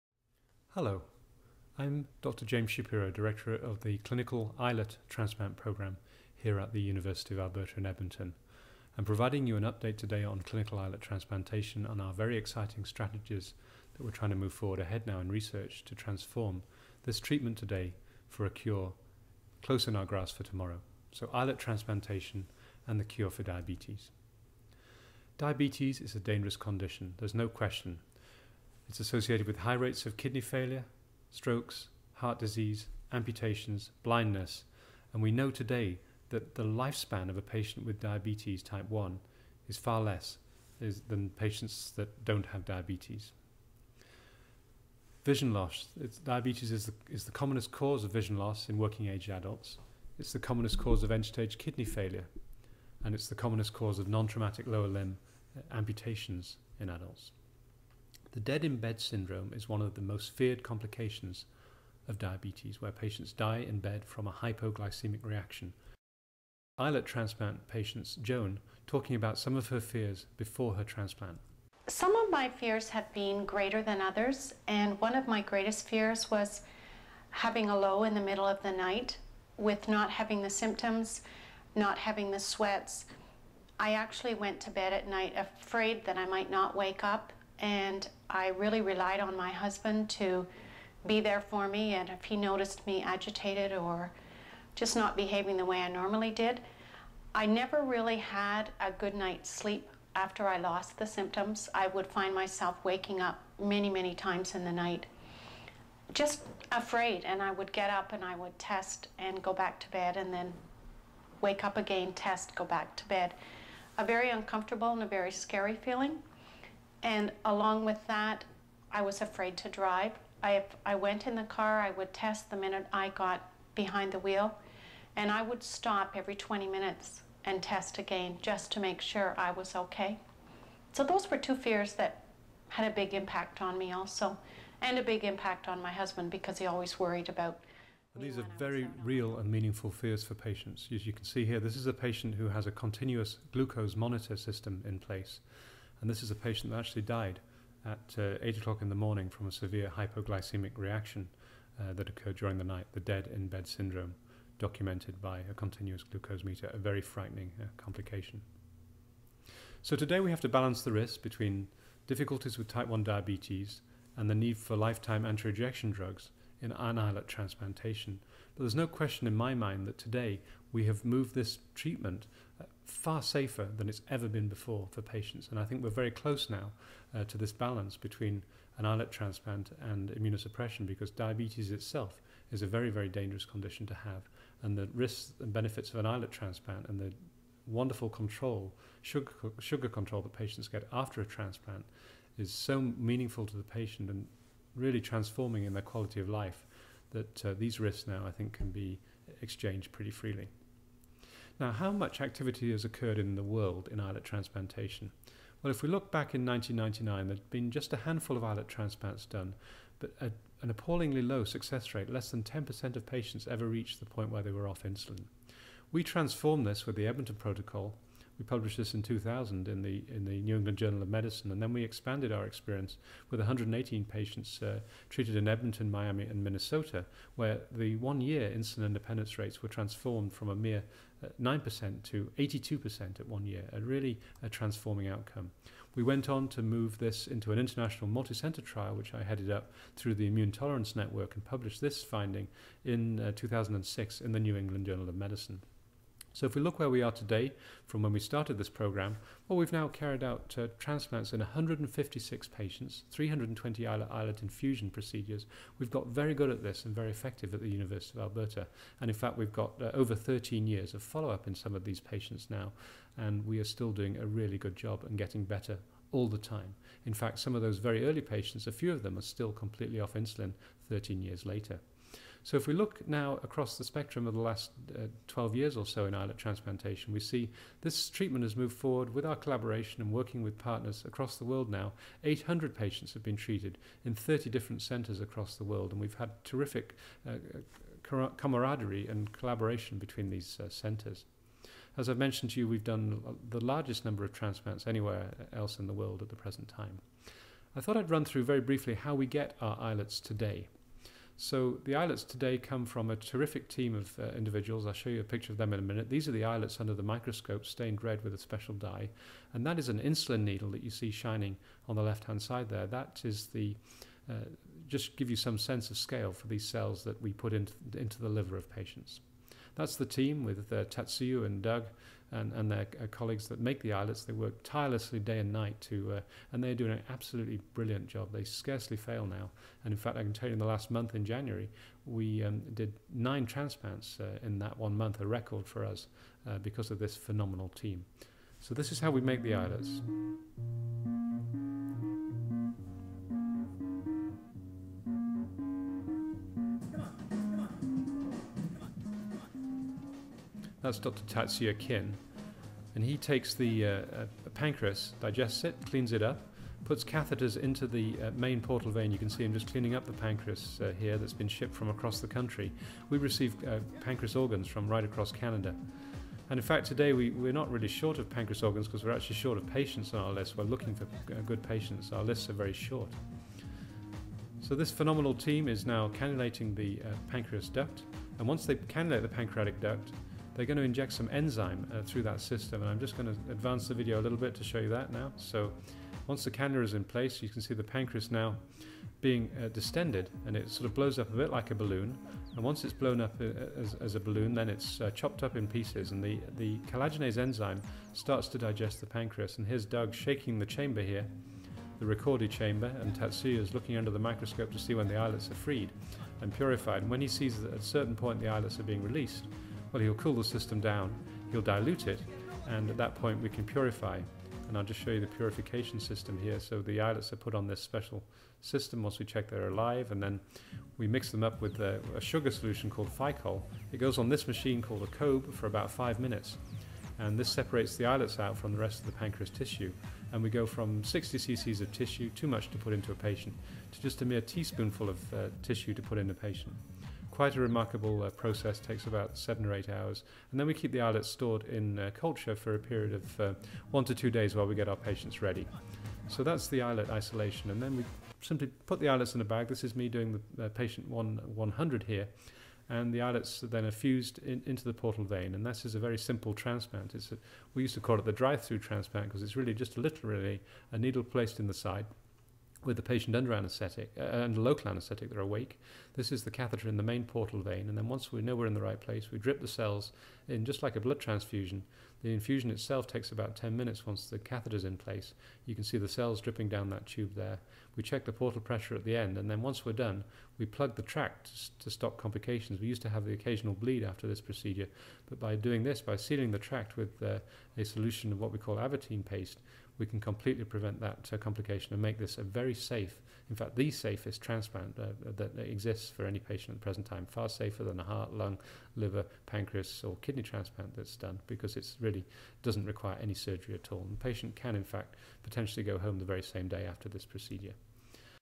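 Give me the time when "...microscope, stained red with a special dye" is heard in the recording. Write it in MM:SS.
05:07.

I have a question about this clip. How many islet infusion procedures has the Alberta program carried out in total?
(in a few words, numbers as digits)
320.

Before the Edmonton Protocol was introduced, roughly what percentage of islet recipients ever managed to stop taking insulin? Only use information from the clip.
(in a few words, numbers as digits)
less than 10%.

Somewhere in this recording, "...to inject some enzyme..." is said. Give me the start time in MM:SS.
06:20.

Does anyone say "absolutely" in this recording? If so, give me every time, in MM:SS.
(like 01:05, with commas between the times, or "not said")
05:27.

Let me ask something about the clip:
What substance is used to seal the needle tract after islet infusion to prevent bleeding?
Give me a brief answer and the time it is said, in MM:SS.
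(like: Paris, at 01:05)
Avitene paste, at 08:08.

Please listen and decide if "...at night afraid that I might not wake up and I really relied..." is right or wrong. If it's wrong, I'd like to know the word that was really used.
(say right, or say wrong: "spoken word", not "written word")
right.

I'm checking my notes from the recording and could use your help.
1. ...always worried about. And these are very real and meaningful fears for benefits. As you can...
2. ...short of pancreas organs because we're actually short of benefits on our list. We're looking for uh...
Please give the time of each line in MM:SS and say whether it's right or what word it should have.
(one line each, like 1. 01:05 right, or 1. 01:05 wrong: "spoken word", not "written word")
1. 02:16 wrong: "patients", not "benefits"
2. 06:07 wrong: "patients", not "benefits".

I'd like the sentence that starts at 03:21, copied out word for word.
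Now, how much activity has occurred in the world in islet transplantation?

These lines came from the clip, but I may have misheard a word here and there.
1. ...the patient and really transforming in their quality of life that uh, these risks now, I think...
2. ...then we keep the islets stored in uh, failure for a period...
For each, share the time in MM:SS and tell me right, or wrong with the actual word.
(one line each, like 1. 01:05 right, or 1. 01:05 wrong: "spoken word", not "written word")
1. 03:13 right
2. 07:20 wrong: "culture", not "failure".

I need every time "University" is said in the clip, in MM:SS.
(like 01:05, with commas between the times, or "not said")
00:06, 04:17.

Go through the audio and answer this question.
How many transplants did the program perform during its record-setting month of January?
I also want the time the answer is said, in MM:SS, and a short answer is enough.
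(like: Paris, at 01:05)
9, at 05:33.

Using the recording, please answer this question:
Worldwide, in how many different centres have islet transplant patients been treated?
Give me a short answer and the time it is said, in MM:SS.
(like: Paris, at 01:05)
30, at 04:44.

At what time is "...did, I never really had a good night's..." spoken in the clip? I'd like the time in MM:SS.
01:36.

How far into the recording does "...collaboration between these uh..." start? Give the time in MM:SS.
04:49.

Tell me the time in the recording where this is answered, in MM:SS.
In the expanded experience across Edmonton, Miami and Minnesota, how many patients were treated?
03:43.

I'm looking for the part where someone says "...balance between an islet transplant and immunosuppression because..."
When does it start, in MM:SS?
02:57.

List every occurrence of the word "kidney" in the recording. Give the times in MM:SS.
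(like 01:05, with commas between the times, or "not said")
00:30, 00:51, 08:20.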